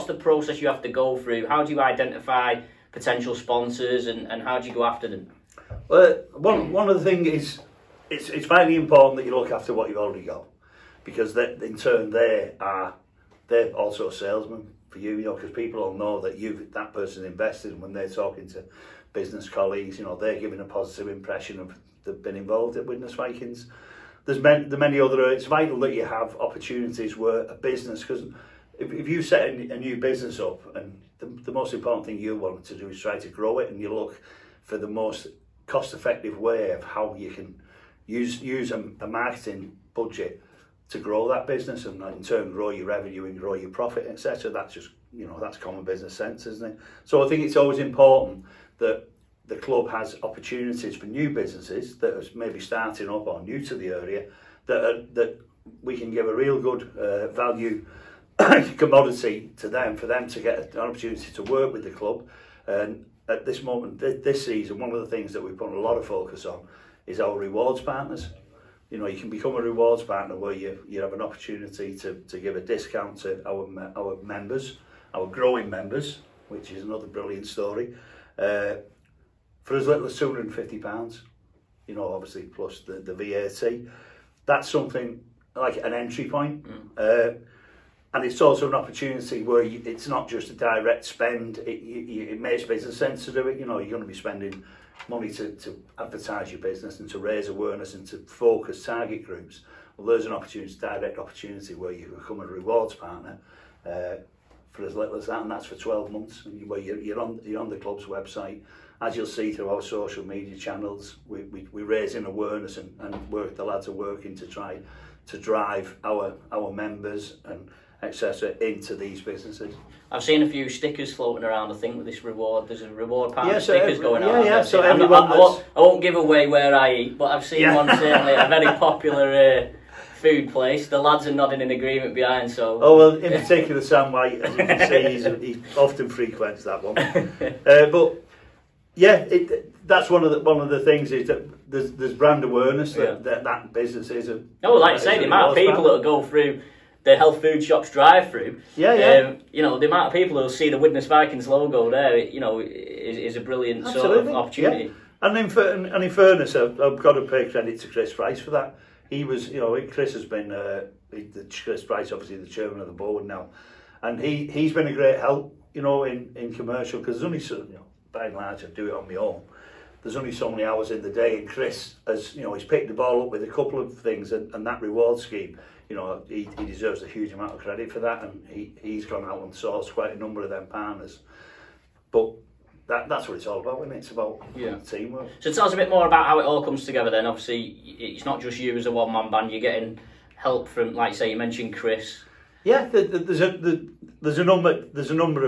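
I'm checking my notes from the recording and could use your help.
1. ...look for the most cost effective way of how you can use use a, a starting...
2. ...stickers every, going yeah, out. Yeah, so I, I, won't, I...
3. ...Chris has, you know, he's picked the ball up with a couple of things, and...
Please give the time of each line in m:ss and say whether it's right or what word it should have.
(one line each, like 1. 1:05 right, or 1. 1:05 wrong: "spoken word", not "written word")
1. 0:33 wrong: "marketing", not "starting"
2. 2:03 right
3. 2:51 right.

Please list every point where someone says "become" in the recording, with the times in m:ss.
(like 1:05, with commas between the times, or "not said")
1:09, 1:42.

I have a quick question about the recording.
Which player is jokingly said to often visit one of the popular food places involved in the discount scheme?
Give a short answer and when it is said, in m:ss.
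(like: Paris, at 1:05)
Sam White, at 2:13.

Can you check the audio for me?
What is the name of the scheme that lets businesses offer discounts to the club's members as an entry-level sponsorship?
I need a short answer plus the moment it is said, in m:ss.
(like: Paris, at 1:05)
rewards partners, at 1:07.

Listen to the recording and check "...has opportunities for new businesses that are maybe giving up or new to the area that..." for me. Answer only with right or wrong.
wrong.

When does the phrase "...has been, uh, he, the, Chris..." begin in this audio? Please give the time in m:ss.
2:40.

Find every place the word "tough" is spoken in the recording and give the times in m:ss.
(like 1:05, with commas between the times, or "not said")
not said.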